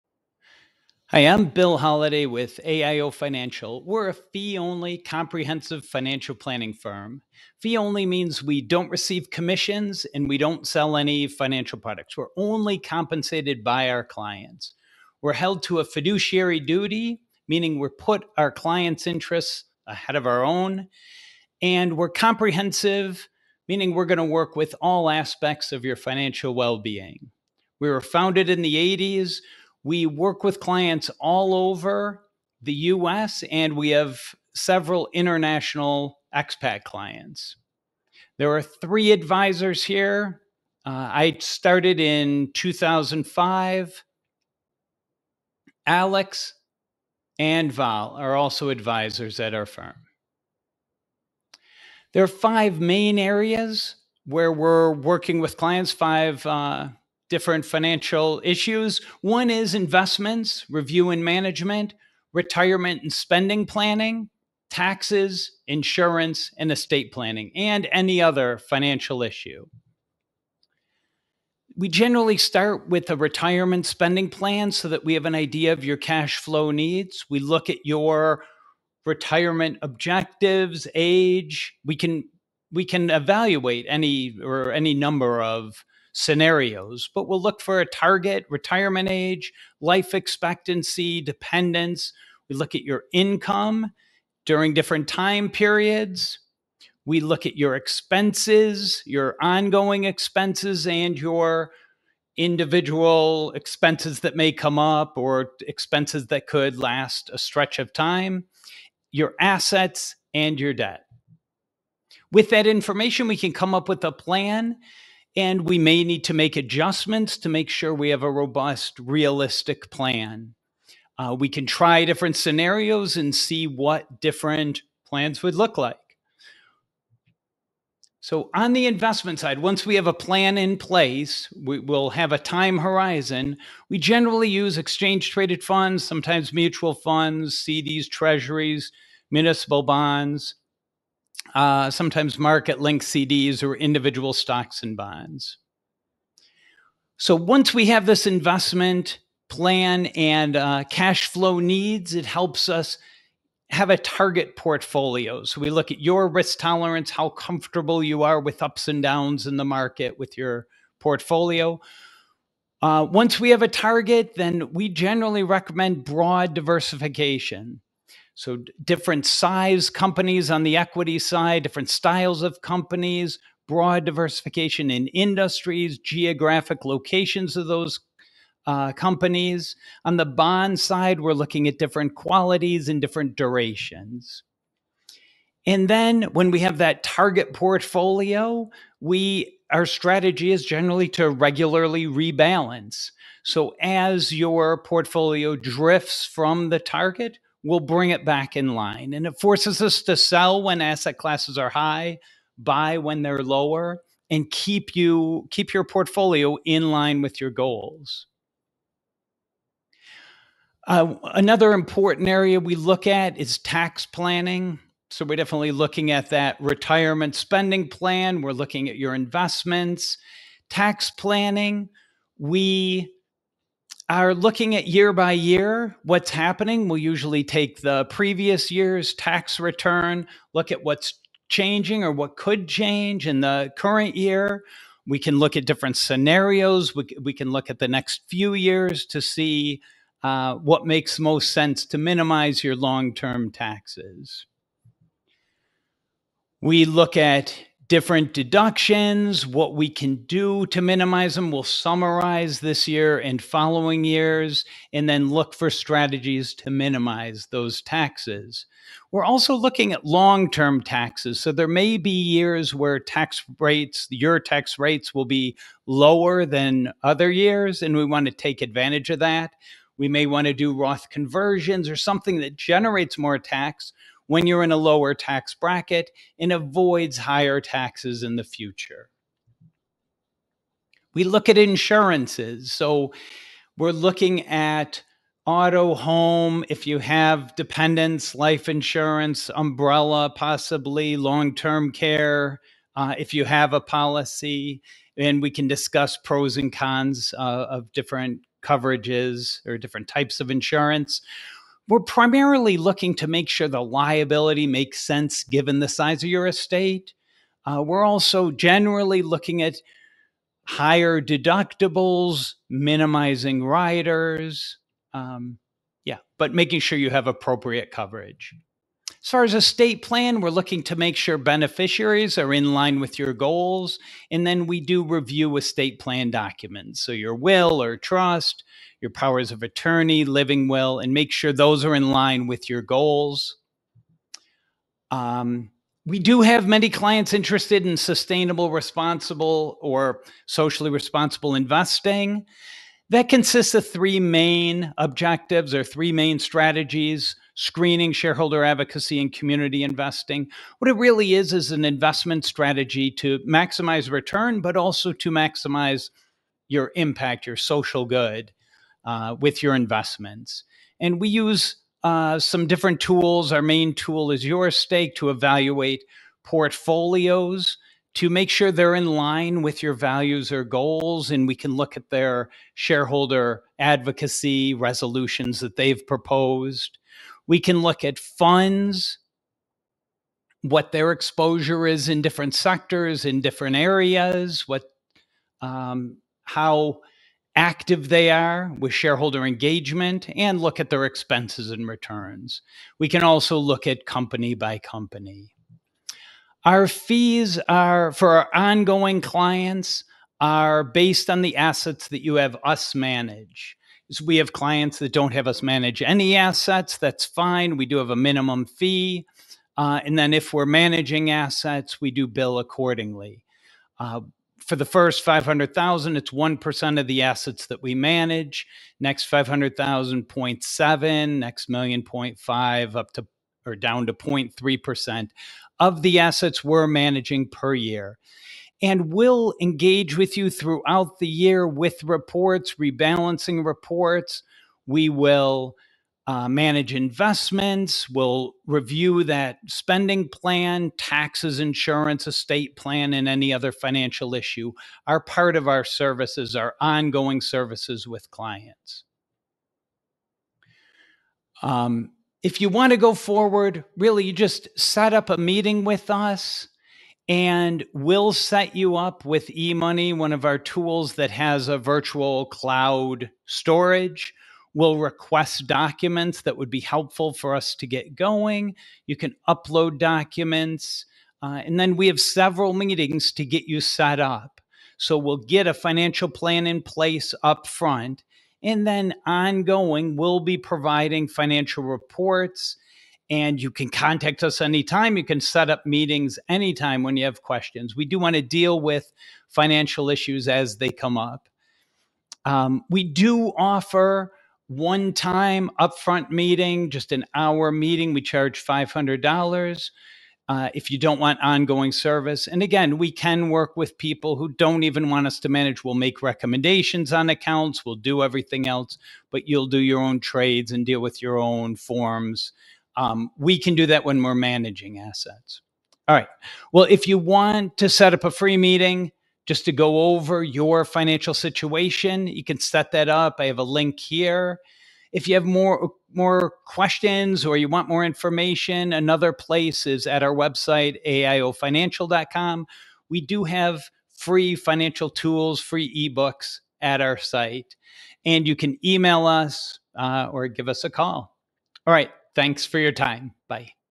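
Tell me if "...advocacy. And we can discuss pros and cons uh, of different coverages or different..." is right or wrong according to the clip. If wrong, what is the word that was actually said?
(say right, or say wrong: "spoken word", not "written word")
wrong: "policy", not "advocacy".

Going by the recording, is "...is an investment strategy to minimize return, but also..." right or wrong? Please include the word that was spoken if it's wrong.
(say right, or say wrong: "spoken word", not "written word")
wrong: "maximize", not "minimize".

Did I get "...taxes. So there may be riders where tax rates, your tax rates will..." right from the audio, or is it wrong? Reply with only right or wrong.
wrong.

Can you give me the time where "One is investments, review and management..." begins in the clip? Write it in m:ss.
0:59.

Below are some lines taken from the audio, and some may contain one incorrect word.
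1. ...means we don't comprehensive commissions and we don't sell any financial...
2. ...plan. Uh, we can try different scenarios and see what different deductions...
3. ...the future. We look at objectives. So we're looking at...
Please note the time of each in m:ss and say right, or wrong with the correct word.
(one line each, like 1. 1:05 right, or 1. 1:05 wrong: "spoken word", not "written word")
1. 0:08 wrong: "receive", not "comprehensive"
2. 1:59 wrong: "plans", not "deductions"
3. 4:38 wrong: "insurances", not "objectives".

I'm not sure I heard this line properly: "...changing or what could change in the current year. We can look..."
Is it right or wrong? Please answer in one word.
right.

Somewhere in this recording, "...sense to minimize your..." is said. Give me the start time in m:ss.
4:01.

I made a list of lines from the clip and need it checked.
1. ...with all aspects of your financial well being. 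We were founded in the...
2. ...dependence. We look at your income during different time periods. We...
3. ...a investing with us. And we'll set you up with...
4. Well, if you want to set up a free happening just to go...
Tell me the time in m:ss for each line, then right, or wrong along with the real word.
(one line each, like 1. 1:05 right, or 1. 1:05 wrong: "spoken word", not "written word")
1. 0:24 right
2. 1:31 right
3. 7:35 wrong: "meeting", not "investing"
4. 8:36 wrong: "meeting", not "happening".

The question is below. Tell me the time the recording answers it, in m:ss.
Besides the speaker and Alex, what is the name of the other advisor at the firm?
0:47.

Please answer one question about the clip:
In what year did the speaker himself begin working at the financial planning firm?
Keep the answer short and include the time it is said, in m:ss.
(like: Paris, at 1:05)
2005, at 0:42.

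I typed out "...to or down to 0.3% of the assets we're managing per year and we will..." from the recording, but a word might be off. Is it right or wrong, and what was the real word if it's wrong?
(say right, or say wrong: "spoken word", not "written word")
right.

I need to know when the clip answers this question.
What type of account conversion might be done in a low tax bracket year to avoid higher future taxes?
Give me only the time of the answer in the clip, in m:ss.
4:30.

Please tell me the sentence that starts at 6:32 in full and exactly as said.
We can also look at company by company.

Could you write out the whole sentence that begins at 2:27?
So once we have this investment plan and uh, cash flow needs, it helps us have a target portfolio.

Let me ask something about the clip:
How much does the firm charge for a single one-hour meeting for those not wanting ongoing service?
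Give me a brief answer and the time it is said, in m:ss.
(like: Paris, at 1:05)
$500, at 8:18.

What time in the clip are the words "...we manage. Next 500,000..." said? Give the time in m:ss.
6:57.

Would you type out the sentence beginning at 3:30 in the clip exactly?
Uh, another important area we look at is tax planning.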